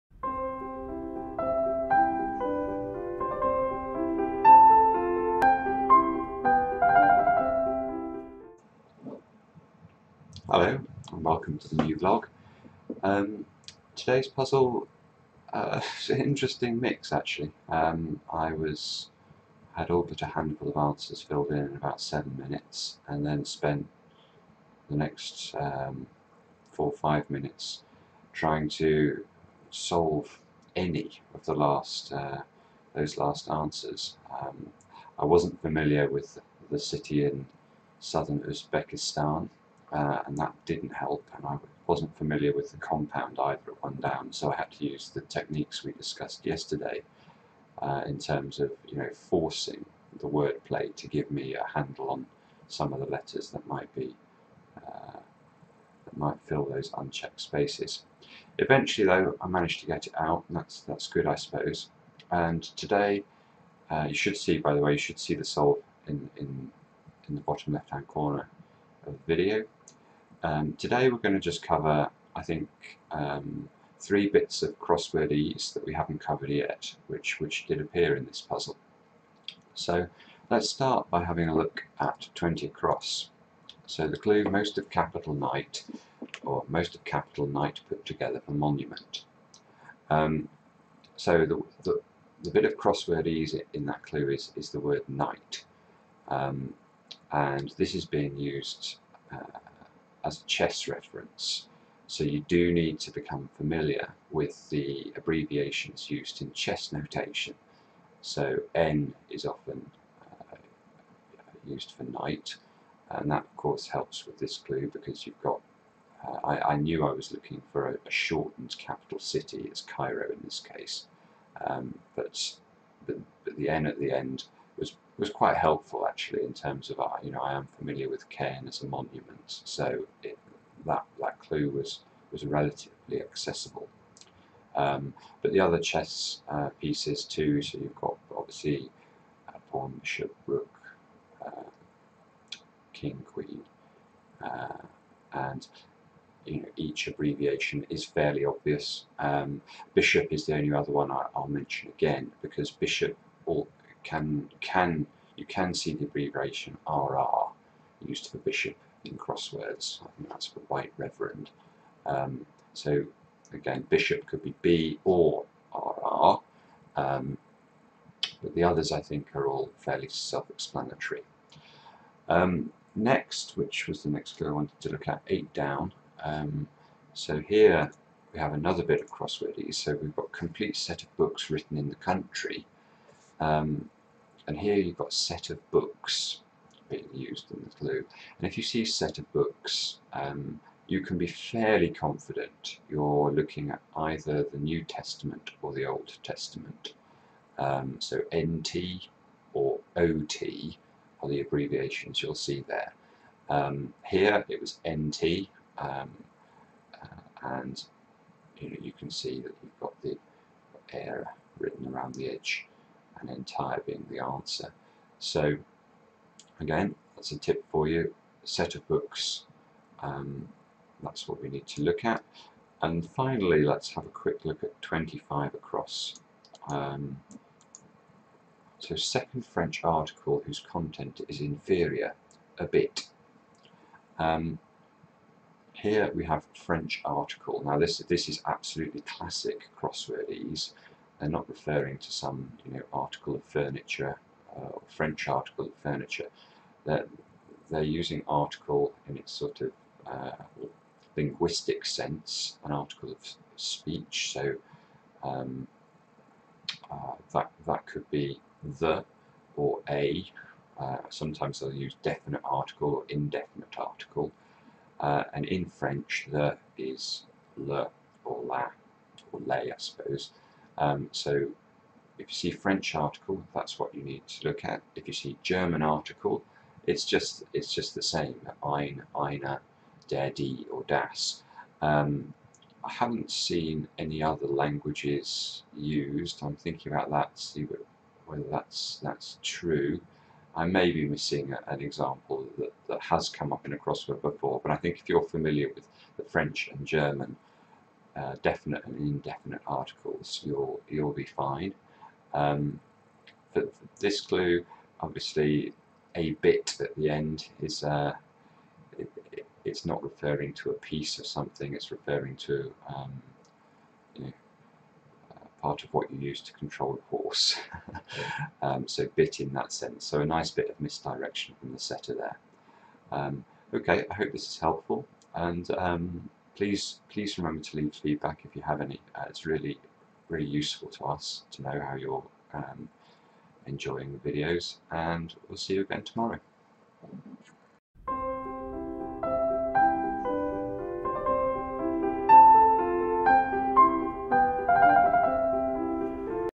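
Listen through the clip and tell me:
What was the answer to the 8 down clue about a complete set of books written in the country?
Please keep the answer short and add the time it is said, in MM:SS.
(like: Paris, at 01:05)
Entire, at 03:33.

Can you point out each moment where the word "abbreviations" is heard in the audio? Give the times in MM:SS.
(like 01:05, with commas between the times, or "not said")
01:45, 02:27, 02:36, 03:21.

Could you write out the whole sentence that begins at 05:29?
Uh, it's really really useful to us to know how you're um, enjoying the videos and we'll see you again tomorrow.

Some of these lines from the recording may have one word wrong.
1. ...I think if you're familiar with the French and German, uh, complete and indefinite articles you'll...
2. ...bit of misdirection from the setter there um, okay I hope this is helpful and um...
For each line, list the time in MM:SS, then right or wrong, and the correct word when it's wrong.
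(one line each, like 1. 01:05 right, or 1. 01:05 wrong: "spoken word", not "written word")
1. 04:54 wrong: "definite", not "complete"
2. 05:20 right.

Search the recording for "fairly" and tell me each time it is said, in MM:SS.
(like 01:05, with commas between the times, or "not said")
02:28, 02:49, 03:11.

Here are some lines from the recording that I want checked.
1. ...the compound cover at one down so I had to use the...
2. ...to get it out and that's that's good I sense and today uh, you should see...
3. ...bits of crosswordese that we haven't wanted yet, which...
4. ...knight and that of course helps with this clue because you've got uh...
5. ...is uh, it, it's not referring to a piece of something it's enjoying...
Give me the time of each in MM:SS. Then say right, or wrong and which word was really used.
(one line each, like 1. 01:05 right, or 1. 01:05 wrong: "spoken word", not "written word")
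1. 00:42 wrong: "either", not "cover"
2. 00:59 wrong: "suppose", not "sense"
3. 01:14 wrong: "covered", not "wanted"
4. 01:52 right
5. 05:07 wrong: "referring", not "enjoying".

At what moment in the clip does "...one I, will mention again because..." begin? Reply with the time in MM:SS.
02:30.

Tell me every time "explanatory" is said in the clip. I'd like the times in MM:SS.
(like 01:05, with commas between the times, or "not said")
02:50.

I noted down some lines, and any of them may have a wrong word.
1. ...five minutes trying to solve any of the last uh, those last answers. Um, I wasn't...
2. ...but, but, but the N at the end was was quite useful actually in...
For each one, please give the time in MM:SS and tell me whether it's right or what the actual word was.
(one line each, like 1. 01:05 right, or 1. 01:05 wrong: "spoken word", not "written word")
1. 00:26 right
2. 02:02 wrong: "helpful", not "useful".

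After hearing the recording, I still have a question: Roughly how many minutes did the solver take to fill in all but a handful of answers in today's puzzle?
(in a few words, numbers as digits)
7.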